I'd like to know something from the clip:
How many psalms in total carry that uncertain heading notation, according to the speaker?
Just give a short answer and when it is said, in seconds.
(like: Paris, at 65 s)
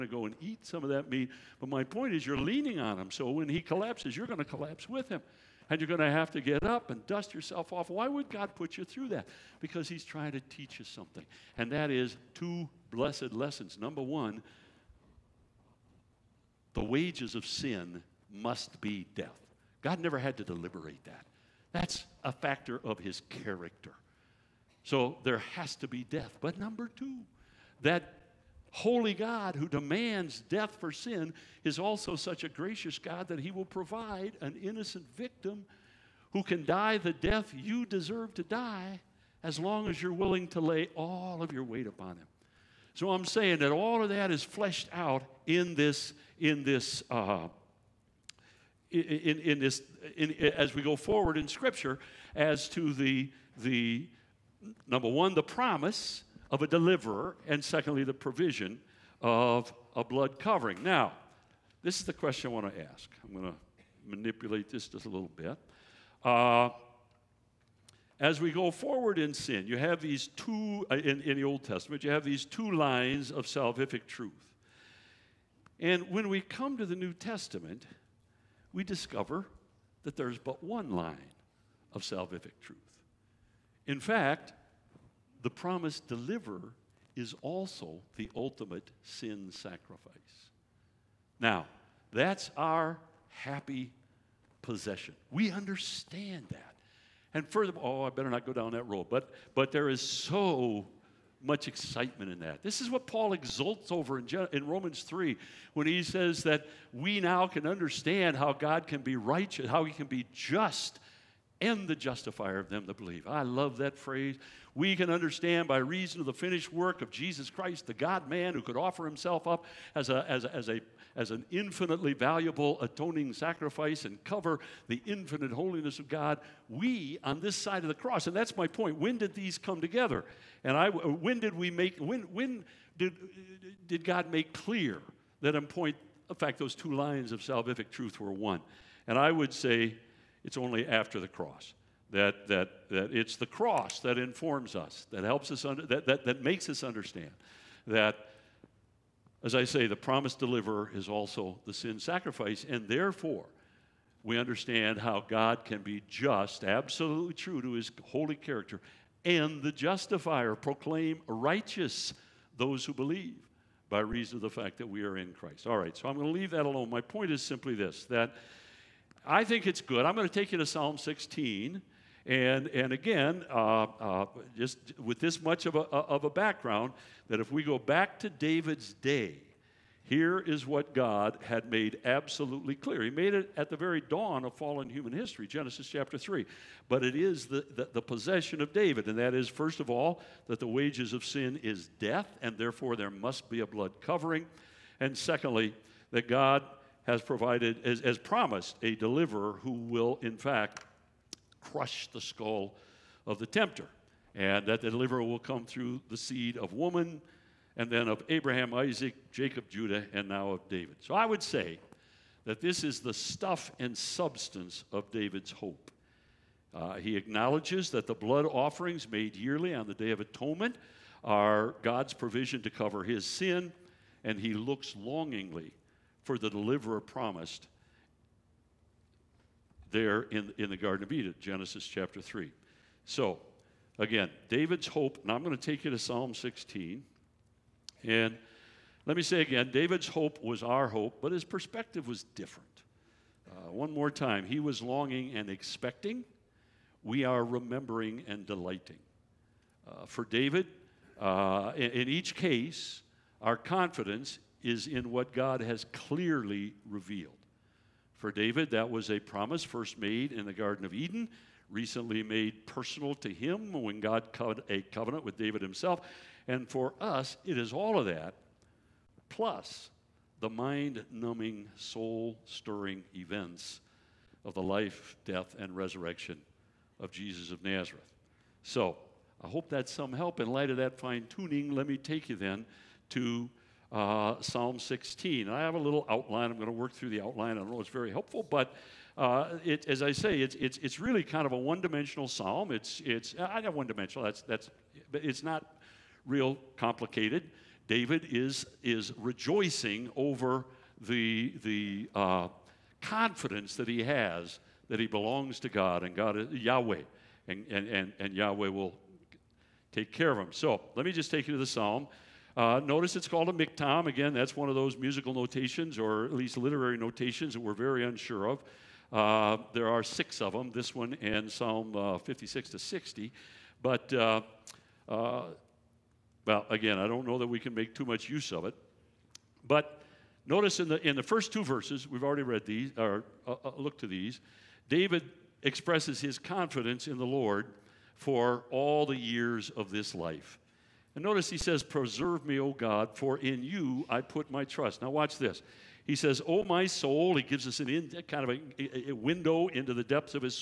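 6, at 320 s.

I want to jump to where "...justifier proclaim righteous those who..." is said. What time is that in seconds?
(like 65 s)
159 s.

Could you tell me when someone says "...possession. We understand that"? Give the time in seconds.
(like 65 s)
94 s.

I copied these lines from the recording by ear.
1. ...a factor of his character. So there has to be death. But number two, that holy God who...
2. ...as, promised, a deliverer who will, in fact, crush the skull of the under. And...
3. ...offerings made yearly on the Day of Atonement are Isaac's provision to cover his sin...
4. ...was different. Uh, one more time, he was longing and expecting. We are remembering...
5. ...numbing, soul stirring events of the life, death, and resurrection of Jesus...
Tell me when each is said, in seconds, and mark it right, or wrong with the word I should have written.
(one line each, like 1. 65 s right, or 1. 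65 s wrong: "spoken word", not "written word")
1. 22 s right
2. 197 s wrong: "tempter", not "under"
3. 218 s wrong: "God", not "Isaac"
4. 242 s right
5. 271 s right.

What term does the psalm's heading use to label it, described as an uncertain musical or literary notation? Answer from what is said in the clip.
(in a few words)
miktam.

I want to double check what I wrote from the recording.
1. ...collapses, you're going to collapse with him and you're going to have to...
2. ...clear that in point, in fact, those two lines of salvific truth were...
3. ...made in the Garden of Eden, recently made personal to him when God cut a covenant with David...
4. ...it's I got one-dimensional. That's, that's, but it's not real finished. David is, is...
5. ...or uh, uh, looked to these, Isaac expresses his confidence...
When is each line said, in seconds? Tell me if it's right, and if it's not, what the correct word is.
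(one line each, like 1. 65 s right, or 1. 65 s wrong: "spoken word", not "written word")
1. 3 s right
2. 134 s right
3. 259 s right
4. 293 s wrong: "complicated", not "finished"
5. 332 s wrong: "David", not "Isaac".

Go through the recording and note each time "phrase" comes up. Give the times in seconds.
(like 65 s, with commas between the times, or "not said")
113 s.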